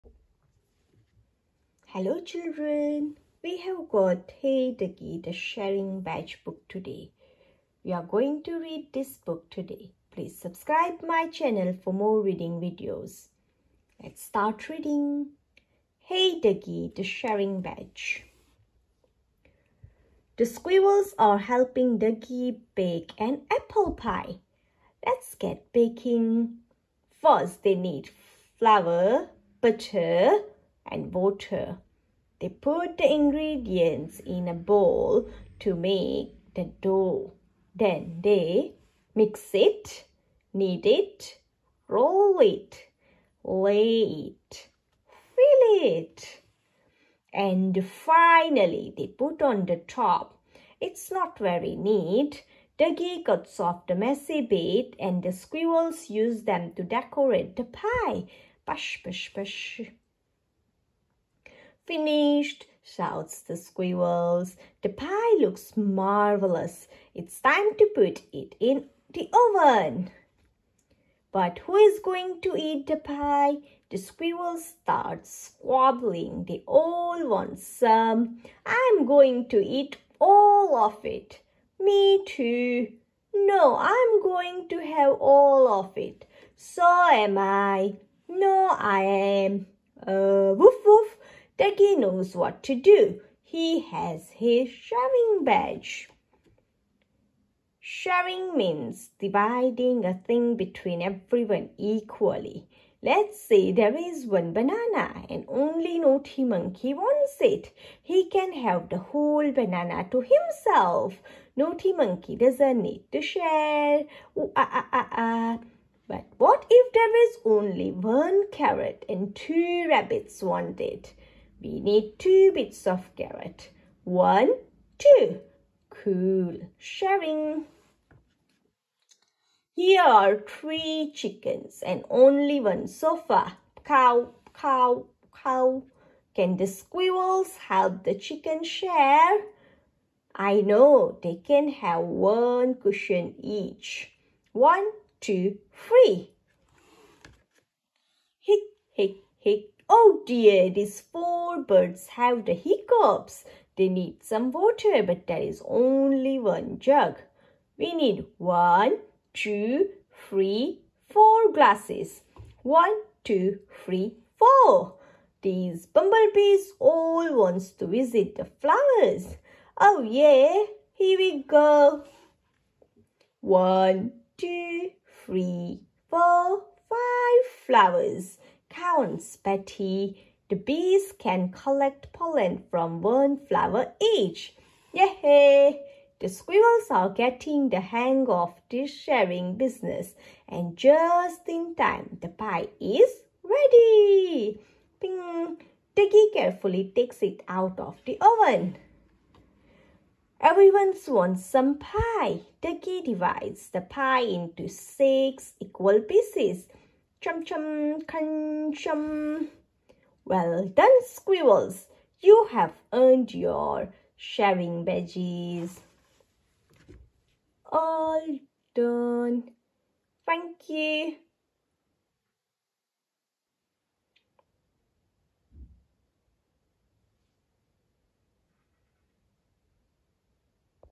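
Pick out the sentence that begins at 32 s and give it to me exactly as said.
They put the ingredients in a bowl to make the dough.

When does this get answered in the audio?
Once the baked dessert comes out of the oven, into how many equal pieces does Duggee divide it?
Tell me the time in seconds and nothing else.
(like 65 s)
204 s.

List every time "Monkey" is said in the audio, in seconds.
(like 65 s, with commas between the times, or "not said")
106 s, 111 s.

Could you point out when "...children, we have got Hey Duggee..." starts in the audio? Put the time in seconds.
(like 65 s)
2 s.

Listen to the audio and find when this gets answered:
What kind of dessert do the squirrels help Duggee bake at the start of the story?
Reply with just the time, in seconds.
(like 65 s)
23 s.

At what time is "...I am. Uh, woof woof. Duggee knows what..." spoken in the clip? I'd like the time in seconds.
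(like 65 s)
88 s.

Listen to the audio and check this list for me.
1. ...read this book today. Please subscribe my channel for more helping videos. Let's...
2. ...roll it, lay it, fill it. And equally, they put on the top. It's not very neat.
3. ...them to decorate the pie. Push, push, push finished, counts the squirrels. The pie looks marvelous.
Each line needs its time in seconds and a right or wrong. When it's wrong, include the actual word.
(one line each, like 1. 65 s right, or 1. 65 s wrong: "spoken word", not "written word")
1. 8 s wrong: "reading", not "helping"
2. 41 s wrong: "finally", not "equally"
3. 56 s wrong: "shouts", not "counts".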